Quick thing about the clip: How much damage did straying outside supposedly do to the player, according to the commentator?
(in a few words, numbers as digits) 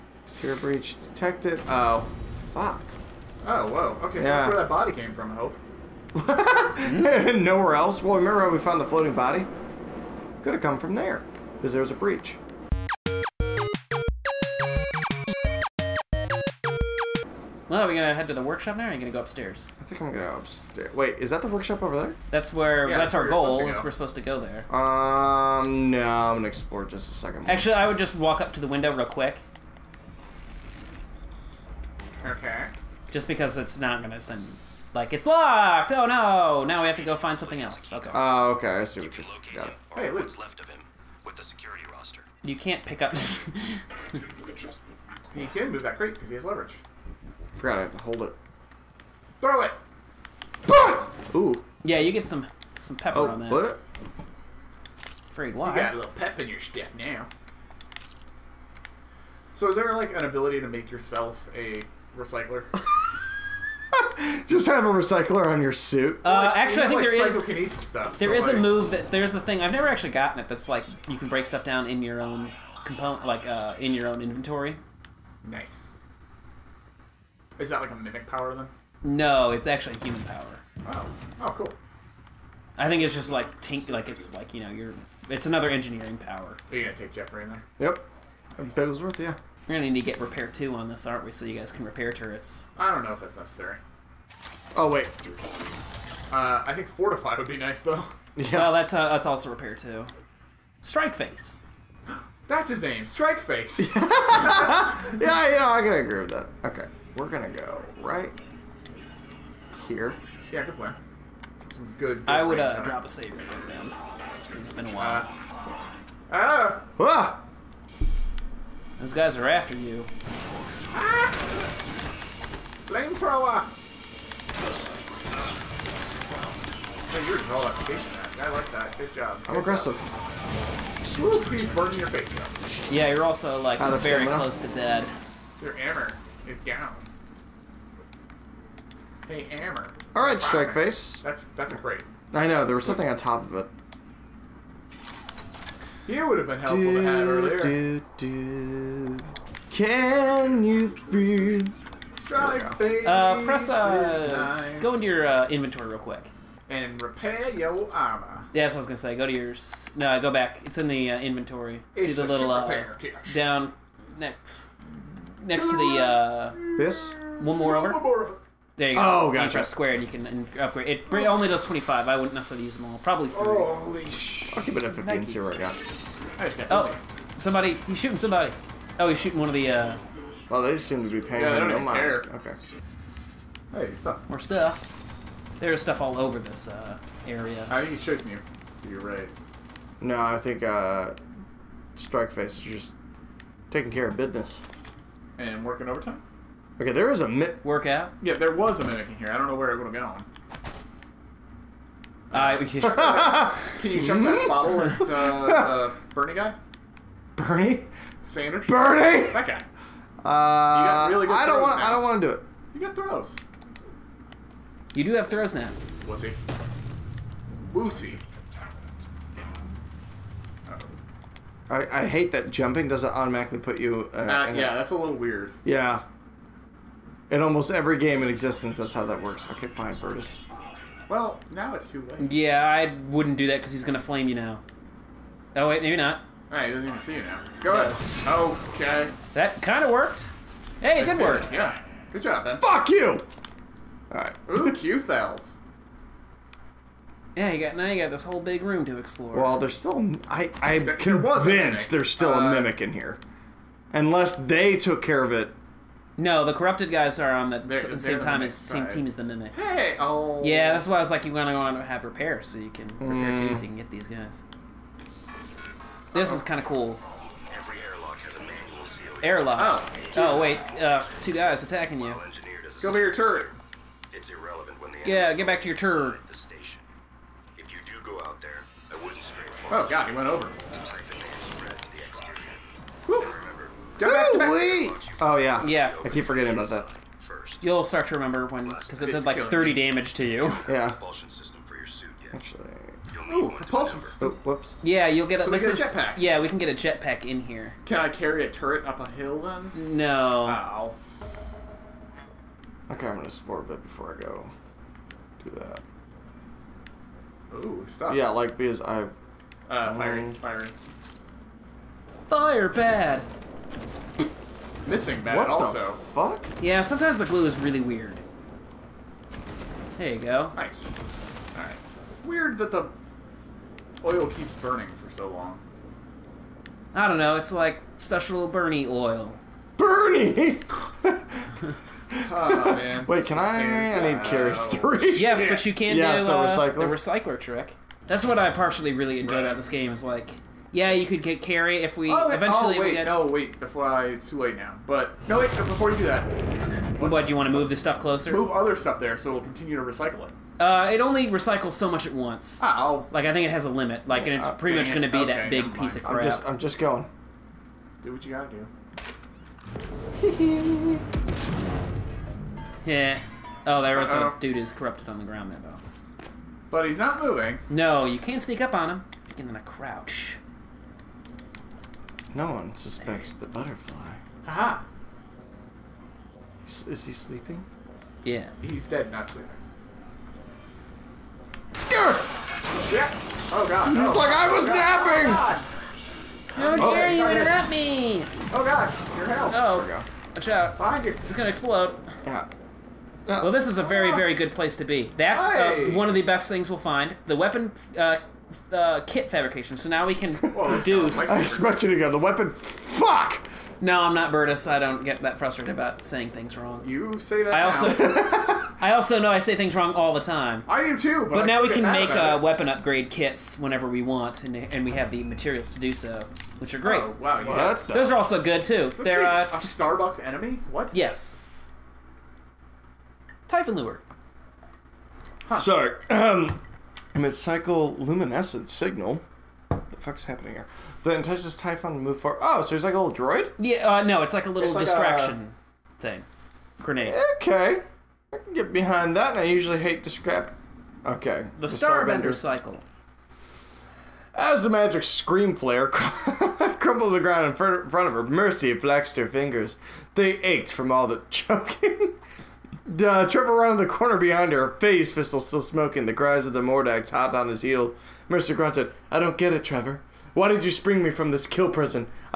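30.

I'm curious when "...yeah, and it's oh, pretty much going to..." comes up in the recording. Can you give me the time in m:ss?
5:54.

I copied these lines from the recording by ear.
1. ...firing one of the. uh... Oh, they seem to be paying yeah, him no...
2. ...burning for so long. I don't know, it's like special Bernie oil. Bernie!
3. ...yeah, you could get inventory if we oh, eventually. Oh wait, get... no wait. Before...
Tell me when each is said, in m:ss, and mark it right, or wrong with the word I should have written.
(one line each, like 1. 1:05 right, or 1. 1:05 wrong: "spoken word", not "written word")
1. 2:59 wrong: "shooting", not "firing"
2. 5:24 right
3. 5:40 wrong: "carry", not "inventory".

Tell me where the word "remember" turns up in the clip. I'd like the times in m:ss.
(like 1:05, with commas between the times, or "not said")
0:08, 4:48.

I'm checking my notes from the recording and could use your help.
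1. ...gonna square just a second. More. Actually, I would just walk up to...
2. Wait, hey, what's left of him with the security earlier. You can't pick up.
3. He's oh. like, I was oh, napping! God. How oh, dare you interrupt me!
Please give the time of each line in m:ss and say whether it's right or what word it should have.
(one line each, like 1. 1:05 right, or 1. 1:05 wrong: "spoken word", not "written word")
1. 0:26 wrong: "explore", not "square"
2. 0:39 wrong: "roster", not "earlier"
3. 6:24 right.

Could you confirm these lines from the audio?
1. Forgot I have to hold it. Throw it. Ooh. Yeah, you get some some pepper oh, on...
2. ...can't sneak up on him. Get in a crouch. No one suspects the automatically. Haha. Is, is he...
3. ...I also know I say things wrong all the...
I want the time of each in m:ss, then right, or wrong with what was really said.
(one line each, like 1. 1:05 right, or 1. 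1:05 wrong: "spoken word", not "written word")
1. 0:47 right
2. 6:08 wrong: "butterfly", not "automatically"
3. 6:48 right.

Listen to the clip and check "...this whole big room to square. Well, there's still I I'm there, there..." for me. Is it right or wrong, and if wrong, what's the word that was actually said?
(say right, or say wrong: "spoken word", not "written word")
wrong: "explore", not "square".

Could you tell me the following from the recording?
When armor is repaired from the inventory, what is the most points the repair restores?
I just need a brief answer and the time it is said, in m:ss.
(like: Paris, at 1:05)
25, at 2:51.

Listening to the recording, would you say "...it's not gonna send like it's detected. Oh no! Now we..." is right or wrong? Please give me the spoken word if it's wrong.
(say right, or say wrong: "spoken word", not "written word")
wrong: "locked", not "detected".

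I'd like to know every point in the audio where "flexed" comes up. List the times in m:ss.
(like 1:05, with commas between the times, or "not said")
7:28.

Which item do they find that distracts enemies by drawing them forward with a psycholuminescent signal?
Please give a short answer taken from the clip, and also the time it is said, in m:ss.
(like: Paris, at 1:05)
Typhon lure, at 7:03.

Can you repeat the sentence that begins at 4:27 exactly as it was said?
Every airlock has a manual seal.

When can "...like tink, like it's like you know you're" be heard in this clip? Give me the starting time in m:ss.
1:23.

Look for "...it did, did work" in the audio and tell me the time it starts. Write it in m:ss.
4:00.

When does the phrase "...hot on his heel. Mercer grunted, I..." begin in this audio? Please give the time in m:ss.
7:37.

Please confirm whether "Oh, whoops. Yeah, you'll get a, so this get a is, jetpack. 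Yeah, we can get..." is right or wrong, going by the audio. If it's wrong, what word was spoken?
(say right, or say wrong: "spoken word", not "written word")
right.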